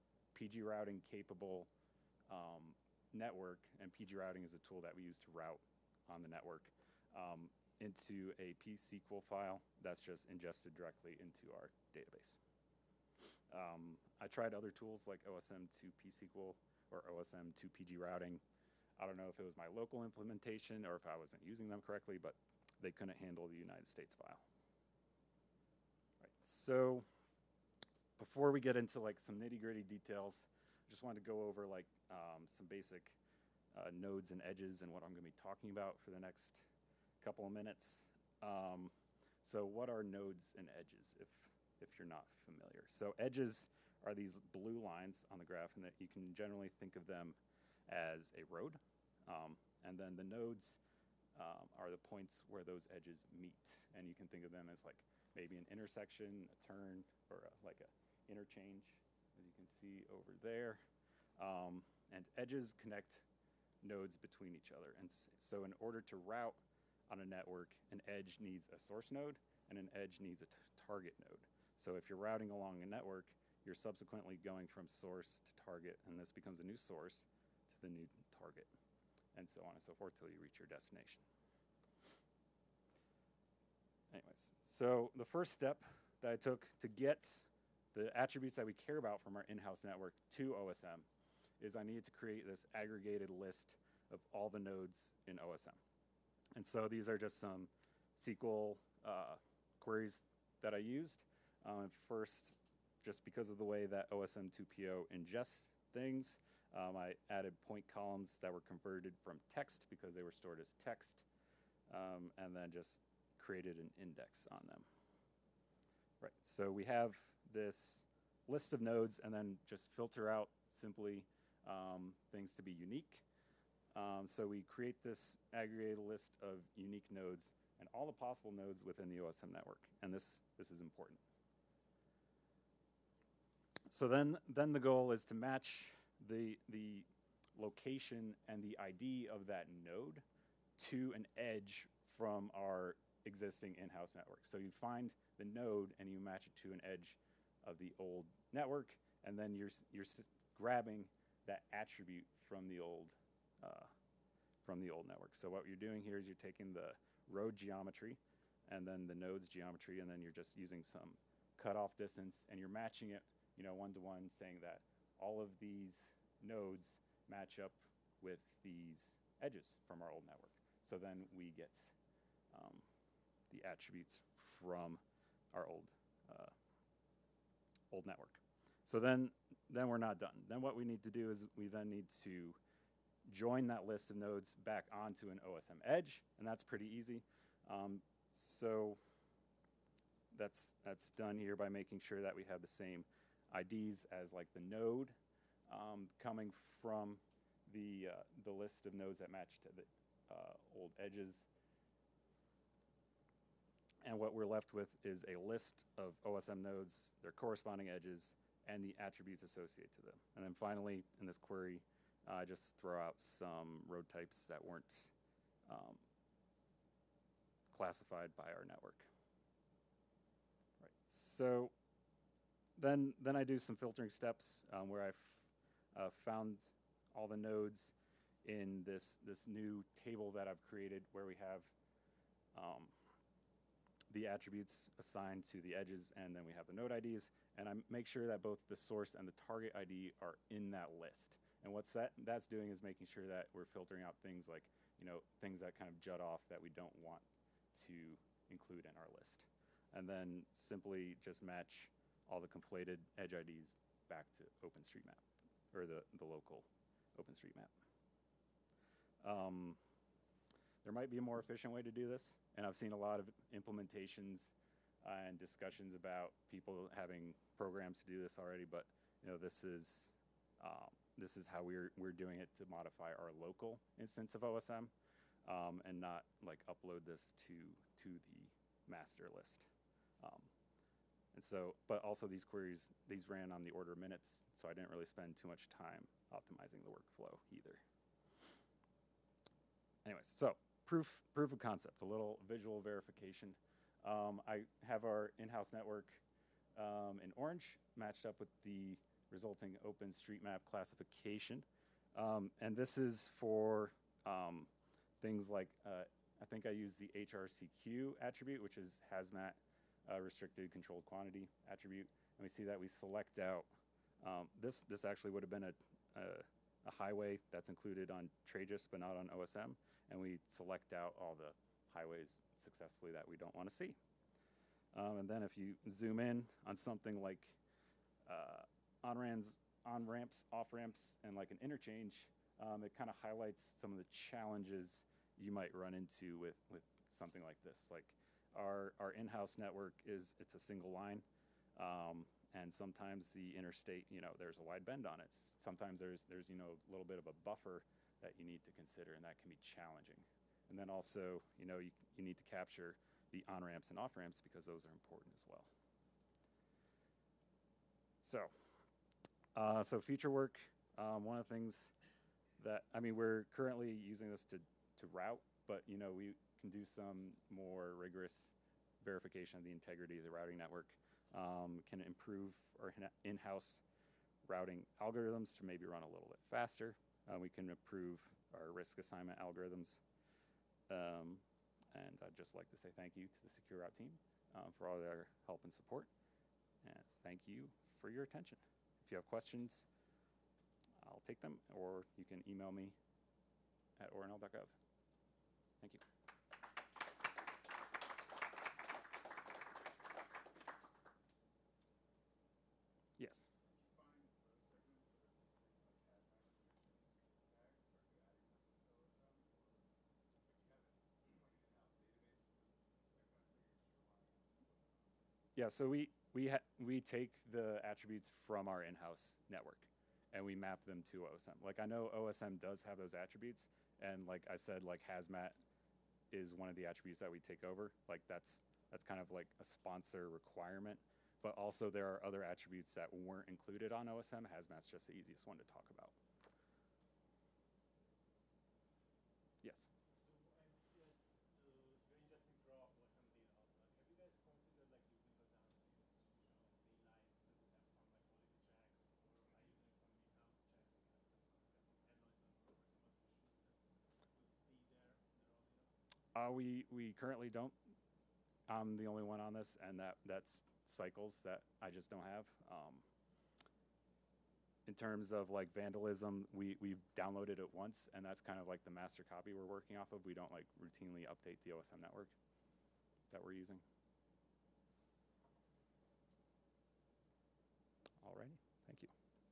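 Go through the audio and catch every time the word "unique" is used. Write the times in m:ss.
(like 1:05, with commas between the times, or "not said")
2:02, 2:06.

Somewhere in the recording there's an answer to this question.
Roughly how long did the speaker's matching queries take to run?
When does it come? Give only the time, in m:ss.
4:43.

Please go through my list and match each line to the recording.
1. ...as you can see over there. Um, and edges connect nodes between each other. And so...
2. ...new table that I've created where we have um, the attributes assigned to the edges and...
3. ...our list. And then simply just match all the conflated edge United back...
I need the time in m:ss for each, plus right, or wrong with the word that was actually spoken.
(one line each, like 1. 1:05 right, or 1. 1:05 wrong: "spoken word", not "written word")
1. 0:59 right
2. 3:49 right
3. 4:08 wrong: "IDs", not "United".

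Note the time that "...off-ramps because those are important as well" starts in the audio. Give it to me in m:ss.
5:53.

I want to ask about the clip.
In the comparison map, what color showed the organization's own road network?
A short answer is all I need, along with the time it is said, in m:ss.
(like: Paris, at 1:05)
orange, at 4:57.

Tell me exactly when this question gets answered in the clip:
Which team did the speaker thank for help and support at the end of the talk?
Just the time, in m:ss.
6:23.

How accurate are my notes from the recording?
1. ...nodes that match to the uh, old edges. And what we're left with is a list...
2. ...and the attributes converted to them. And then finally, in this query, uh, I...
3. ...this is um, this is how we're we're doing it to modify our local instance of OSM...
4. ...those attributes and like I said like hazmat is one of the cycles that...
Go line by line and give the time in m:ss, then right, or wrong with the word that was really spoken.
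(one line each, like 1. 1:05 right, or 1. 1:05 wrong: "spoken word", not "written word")
1. 3:18 right
2. 3:28 wrong: "associated", not "converted"
3. 4:29 right
4. 7:02 wrong: "attributes", not "cycles".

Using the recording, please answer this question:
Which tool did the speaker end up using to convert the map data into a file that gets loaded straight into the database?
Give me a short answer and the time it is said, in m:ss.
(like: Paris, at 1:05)
OSM2PO, at 1:44.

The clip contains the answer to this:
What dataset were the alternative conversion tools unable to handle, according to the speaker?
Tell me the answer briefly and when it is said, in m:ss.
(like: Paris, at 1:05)
the United States file, at 0:23.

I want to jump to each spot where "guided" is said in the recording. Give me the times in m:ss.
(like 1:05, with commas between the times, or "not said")
not said.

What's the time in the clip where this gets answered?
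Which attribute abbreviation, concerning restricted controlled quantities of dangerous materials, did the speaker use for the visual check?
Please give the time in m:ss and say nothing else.
5:07.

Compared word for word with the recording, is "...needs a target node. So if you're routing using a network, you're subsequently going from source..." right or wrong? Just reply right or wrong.
wrong.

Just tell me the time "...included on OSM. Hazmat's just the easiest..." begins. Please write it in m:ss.
7:13.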